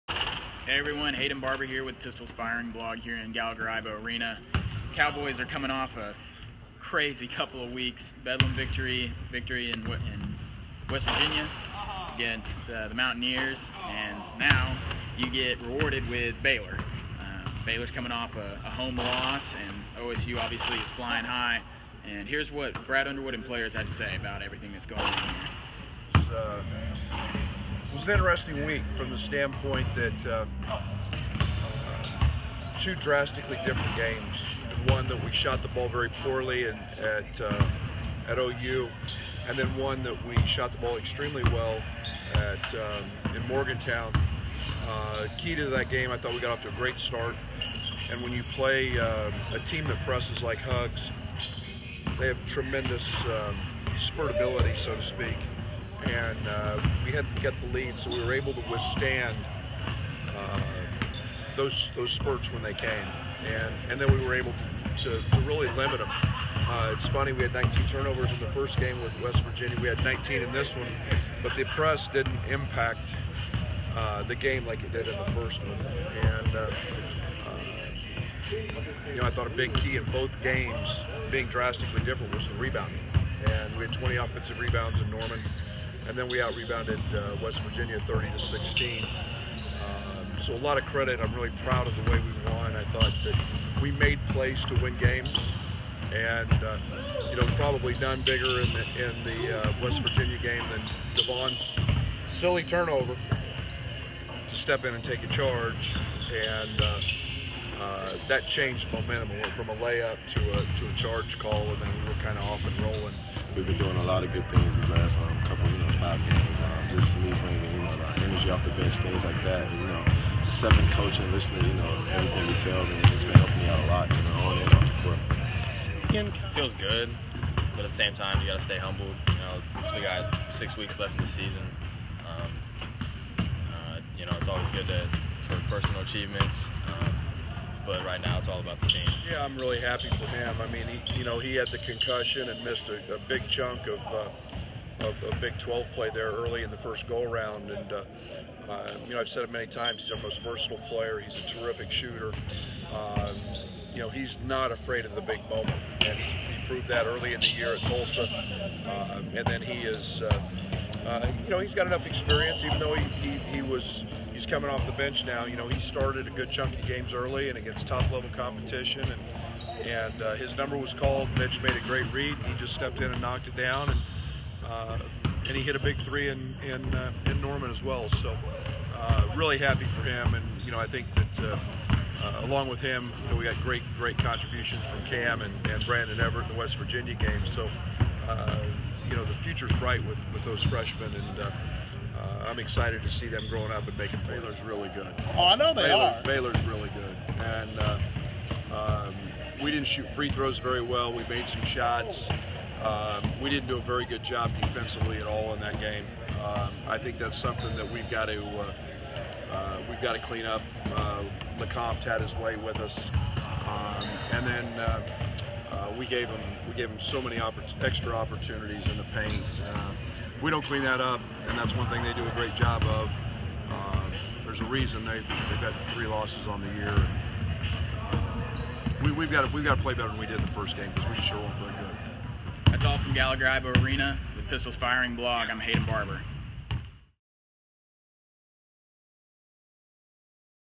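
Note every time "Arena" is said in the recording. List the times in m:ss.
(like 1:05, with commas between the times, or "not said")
0:04, 3:53.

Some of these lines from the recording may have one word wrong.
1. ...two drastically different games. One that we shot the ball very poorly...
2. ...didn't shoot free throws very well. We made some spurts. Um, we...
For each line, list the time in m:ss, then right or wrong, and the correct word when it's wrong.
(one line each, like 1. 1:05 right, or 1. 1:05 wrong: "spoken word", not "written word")
1. 0:32 right
2. 3:19 wrong: "shots", not "spurts".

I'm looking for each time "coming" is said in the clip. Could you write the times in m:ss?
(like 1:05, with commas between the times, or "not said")
0:05, 0:17, 2:44.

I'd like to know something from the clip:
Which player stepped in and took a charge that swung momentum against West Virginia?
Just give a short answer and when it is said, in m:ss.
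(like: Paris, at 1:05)
Davon Dillard, at 1:41.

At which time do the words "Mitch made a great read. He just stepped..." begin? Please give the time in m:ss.
2:51.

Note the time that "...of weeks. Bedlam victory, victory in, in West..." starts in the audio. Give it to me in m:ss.
0:07.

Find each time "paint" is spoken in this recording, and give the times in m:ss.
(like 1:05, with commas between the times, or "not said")
3:39.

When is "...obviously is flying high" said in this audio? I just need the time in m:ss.
0:20.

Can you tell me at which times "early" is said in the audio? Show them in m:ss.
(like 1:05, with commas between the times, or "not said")
2:26, 2:37, 2:47.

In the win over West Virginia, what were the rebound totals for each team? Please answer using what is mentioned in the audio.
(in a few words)
30 to 16.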